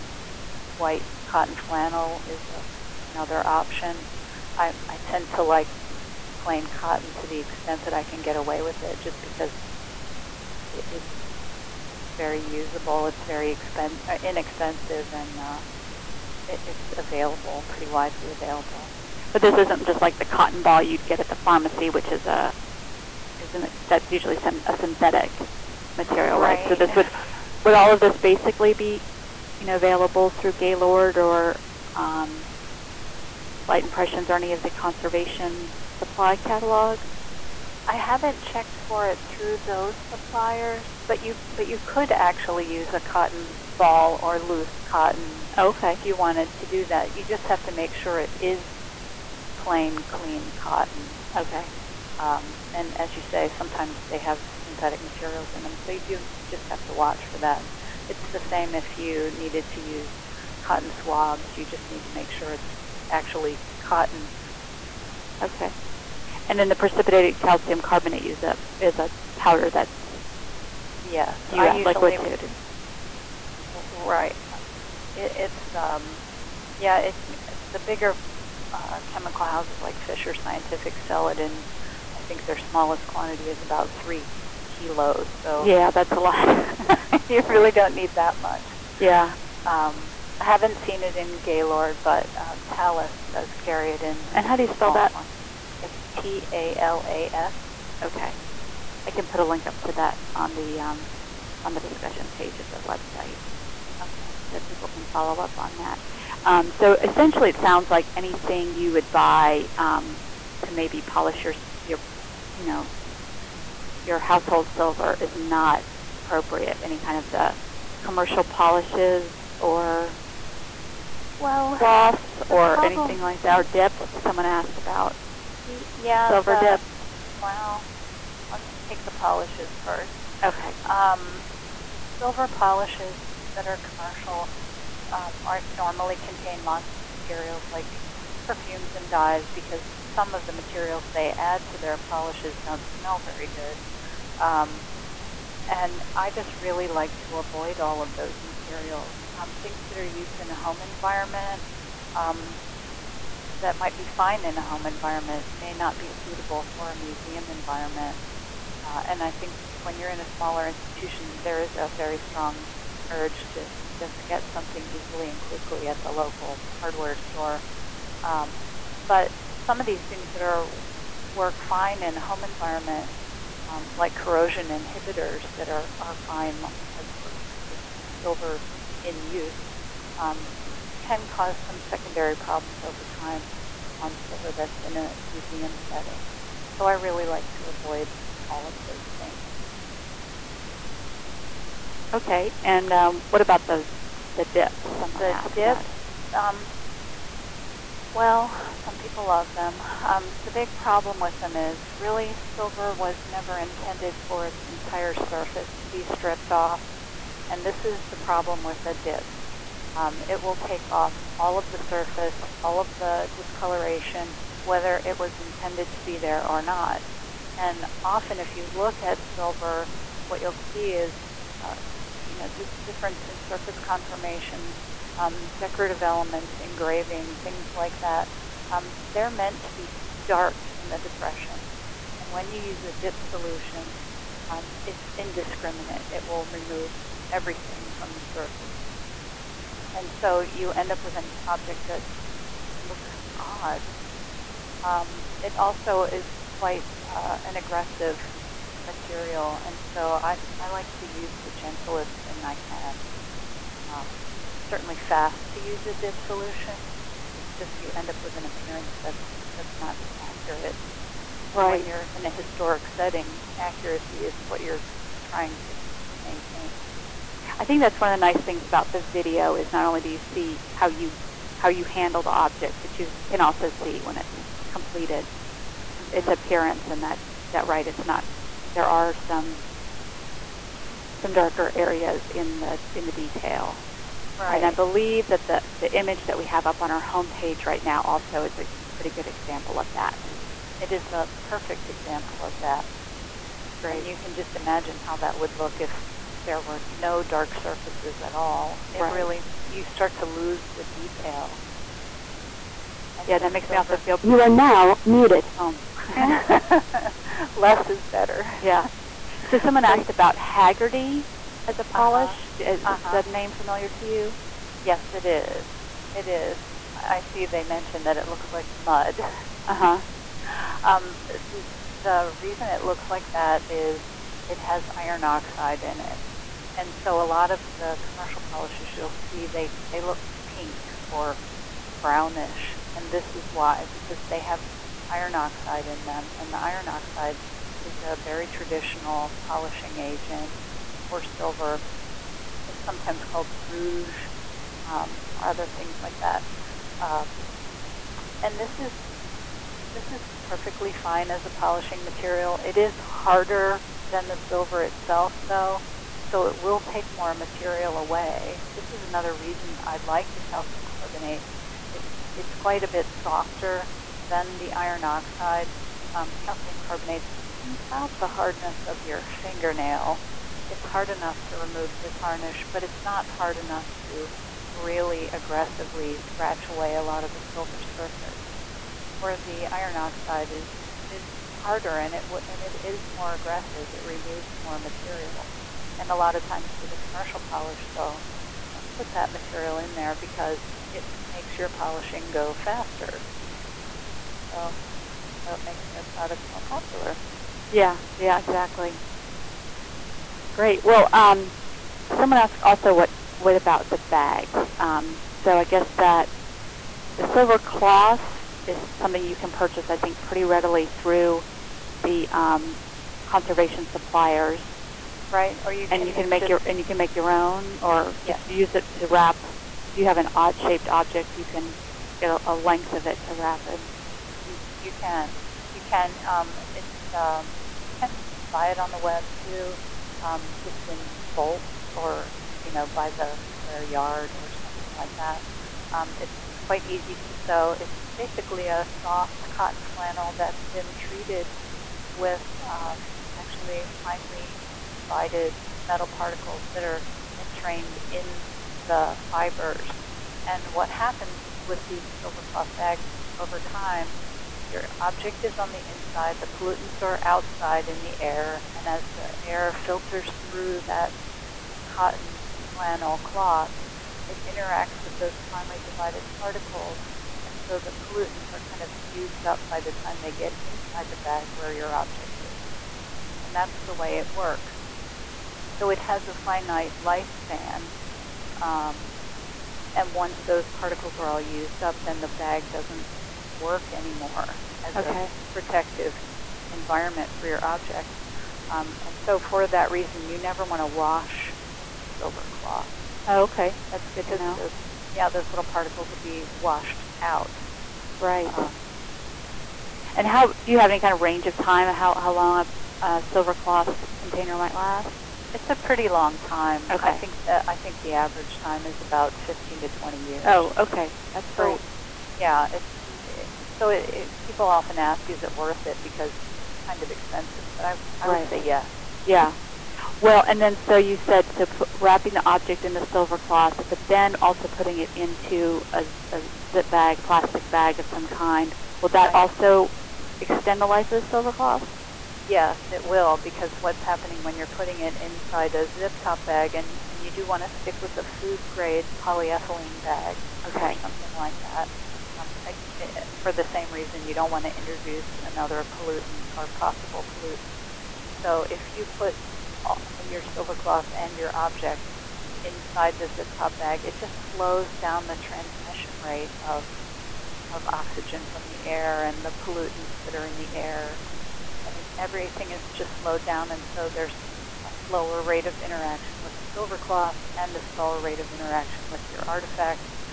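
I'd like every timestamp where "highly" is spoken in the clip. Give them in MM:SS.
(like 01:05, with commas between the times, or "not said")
not said.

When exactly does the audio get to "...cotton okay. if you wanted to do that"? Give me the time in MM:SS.
00:44.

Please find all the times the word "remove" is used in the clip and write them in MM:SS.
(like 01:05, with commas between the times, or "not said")
03:56, 06:11, 06:24.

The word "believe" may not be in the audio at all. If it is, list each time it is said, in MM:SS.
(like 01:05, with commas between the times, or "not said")
04:44.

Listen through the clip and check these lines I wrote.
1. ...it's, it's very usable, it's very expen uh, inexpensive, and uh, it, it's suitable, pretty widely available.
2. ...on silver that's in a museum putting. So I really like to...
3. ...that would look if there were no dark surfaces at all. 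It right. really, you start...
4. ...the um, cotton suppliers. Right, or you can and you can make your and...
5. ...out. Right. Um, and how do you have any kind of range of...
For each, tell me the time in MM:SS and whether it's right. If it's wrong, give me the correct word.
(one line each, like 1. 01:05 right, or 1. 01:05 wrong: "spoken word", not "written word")
1. 00:10 wrong: "available", not "suitable"
2. 03:03 wrong: "setting", not "putting"
3. 04:55 right
4. 06:52 wrong: "conservation", not "cotton"
5. 08:17 right.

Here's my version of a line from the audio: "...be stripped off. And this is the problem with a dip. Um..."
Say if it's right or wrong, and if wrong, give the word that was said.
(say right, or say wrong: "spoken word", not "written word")
right.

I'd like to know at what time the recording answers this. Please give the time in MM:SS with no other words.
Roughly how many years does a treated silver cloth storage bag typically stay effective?
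08:29.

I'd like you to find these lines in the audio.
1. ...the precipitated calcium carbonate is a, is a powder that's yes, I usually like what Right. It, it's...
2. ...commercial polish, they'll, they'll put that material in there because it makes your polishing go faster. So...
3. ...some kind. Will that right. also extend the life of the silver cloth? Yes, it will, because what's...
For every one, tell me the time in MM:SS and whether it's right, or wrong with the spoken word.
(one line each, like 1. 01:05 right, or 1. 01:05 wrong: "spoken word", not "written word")
1. 01:06 right
2. 06:26 right
3. 08:48 right.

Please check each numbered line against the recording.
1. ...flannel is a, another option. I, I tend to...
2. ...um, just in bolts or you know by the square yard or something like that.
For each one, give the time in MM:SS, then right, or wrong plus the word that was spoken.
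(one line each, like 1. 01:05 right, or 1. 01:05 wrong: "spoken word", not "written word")
1. 00:01 right
2. 07:10 right.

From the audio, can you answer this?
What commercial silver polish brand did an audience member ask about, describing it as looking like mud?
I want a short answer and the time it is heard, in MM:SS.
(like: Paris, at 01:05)
Hagerty, at 05:10.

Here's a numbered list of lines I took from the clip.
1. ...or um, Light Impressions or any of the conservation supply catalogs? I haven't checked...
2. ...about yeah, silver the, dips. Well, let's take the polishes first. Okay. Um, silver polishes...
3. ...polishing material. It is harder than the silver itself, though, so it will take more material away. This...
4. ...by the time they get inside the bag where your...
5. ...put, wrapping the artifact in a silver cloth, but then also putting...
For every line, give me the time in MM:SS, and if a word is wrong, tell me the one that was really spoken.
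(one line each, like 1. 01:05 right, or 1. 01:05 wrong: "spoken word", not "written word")
1. 00:31 right
2. 02:04 right
3. 05:51 right
4. 07:49 right
5. 08:41 wrong: "object", not "artifact".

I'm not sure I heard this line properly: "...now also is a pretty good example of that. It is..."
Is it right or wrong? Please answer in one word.
right.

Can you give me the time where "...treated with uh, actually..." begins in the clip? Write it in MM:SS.
07:20.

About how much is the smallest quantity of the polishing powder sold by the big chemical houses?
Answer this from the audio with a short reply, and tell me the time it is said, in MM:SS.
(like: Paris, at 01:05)
3 kilos, at 01:24.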